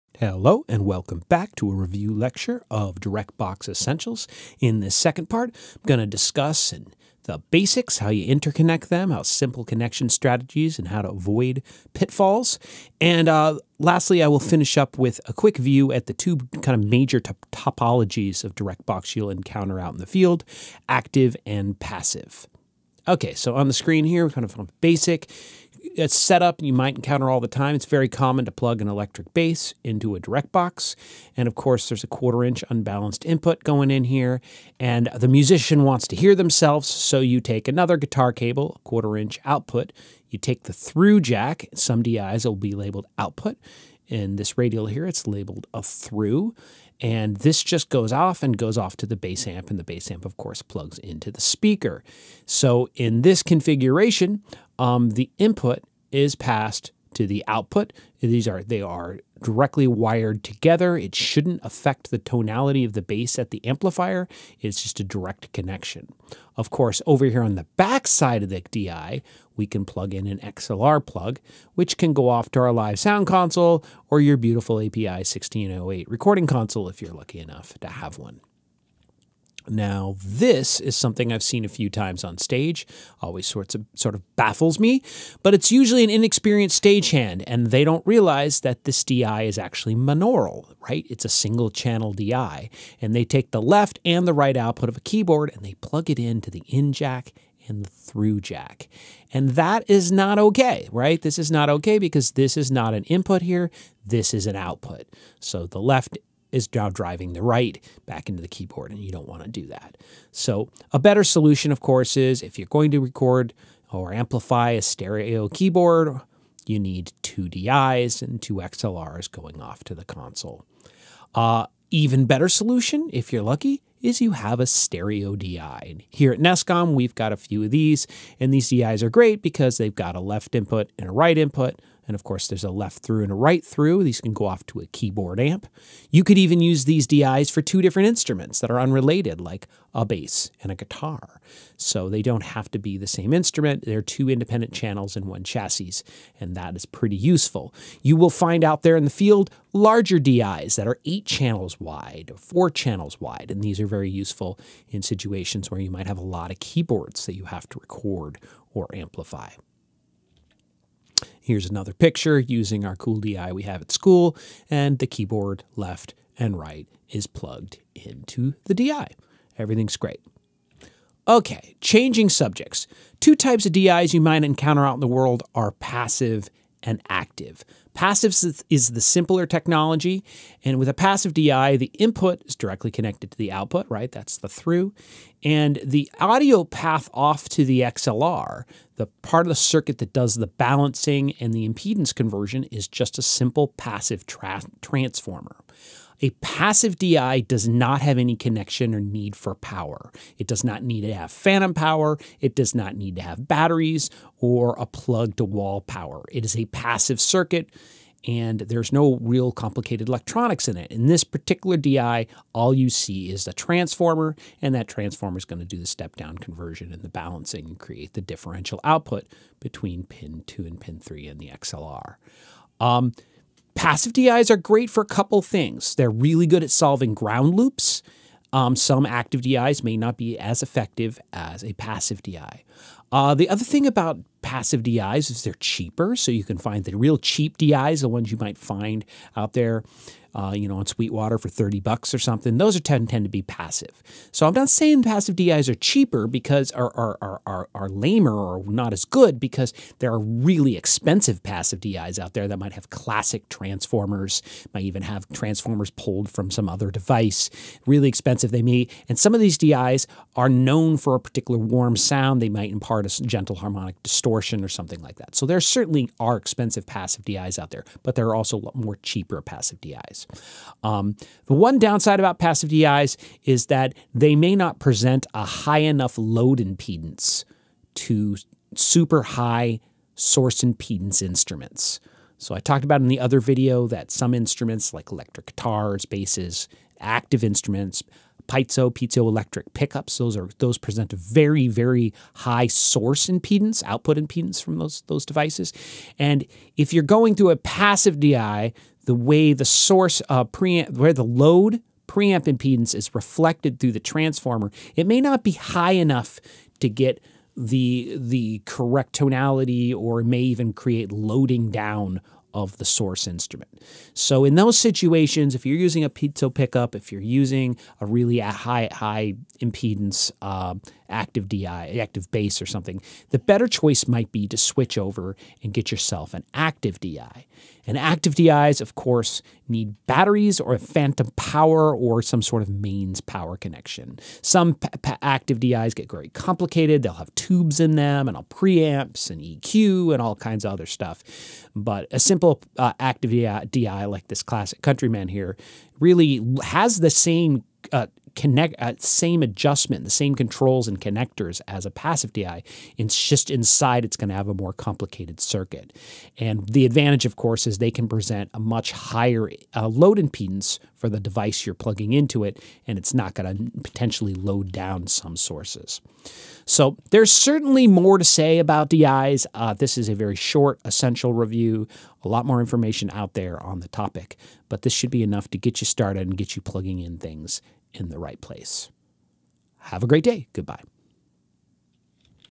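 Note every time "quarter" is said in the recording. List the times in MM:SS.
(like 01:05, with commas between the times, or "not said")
00:32, 00:38.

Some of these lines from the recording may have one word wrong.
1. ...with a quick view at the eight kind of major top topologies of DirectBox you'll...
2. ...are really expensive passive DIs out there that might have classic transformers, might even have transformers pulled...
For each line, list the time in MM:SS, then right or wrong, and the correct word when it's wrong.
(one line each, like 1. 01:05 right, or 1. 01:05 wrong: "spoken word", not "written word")
1. 00:14 wrong: "two", not "eight"
2. 04:10 right.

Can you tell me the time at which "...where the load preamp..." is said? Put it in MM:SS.
05:00.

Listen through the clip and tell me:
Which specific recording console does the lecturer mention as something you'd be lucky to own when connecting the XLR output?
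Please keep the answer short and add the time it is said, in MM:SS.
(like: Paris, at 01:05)
API 1608, at 01:14.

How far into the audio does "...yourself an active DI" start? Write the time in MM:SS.
05:25.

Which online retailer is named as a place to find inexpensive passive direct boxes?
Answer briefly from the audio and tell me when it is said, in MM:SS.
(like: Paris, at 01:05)
Sweetwater, at 04:00.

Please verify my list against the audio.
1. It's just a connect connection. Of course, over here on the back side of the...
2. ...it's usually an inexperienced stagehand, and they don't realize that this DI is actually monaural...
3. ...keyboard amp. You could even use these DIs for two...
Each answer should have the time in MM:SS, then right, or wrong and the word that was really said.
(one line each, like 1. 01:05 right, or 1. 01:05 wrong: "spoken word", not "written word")
1. 01:04 wrong: "direct", not "connect"
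2. 01:25 right
3. 02:14 right.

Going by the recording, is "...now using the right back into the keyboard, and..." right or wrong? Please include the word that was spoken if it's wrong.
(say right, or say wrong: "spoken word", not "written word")
wrong: "driving", not "using".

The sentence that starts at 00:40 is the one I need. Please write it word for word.
You take the through jack, some DIs will be labeled output.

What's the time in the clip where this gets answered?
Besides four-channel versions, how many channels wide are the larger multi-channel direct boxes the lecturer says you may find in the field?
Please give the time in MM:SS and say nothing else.
02:31.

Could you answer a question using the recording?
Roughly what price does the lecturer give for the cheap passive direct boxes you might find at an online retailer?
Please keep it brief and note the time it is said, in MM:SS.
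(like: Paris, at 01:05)
$30, at 04:01.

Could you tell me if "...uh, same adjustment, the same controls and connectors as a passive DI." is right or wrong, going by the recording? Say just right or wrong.
right.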